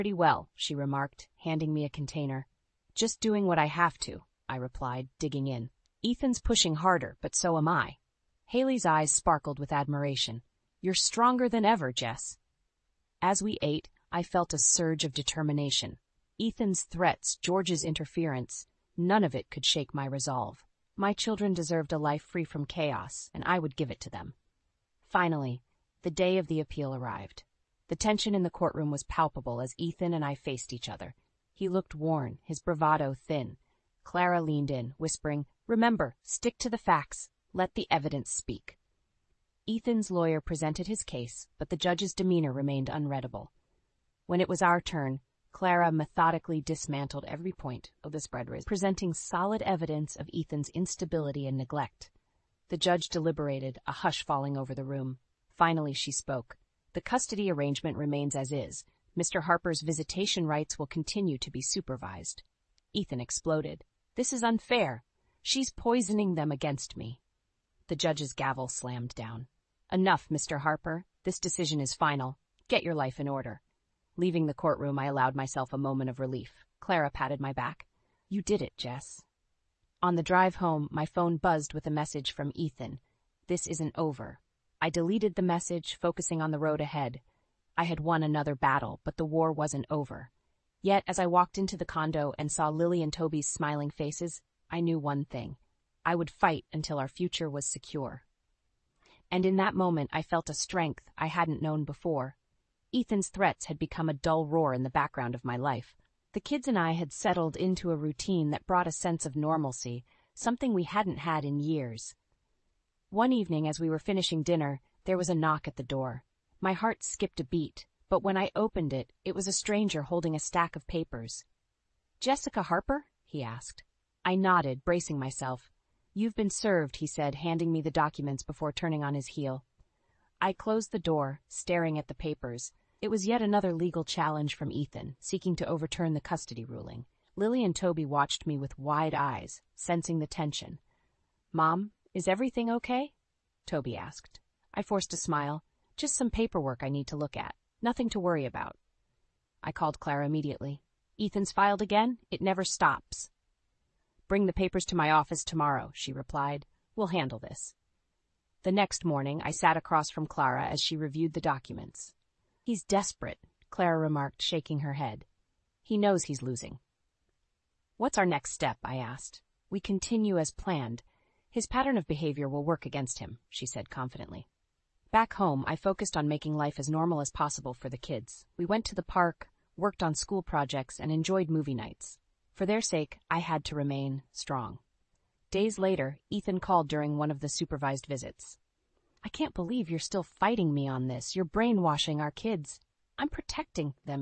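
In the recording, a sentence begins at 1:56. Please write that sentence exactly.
My heart skipped a beat, but when I opened it, it was a stranger holding a stack of papers.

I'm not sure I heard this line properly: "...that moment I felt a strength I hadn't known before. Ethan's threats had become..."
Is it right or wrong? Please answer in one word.
right.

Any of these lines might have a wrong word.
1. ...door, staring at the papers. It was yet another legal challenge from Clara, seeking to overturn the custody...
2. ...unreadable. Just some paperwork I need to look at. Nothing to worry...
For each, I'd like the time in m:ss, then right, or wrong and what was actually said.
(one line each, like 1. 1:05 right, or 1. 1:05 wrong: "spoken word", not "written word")
1. 2:10 wrong: "Ethan", not "Clara"
2. 2:25 wrong: "smile", not "unreadable".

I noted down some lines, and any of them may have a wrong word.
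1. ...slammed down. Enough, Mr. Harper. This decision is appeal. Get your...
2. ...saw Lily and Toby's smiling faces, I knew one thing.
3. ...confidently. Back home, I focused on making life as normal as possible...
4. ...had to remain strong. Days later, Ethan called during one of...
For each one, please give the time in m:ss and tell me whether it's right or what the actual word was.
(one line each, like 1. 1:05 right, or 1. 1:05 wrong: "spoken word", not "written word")
1. 1:08 wrong: "final", not "appeal"
2. 1:32 right
3. 2:53 right
4. 3:03 right.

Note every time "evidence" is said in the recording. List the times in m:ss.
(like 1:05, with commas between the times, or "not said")
0:37, 0:49.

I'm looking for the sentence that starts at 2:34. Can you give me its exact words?
Bring the papers to my office tomorrow, she replied.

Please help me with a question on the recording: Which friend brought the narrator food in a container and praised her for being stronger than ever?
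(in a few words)
Haley.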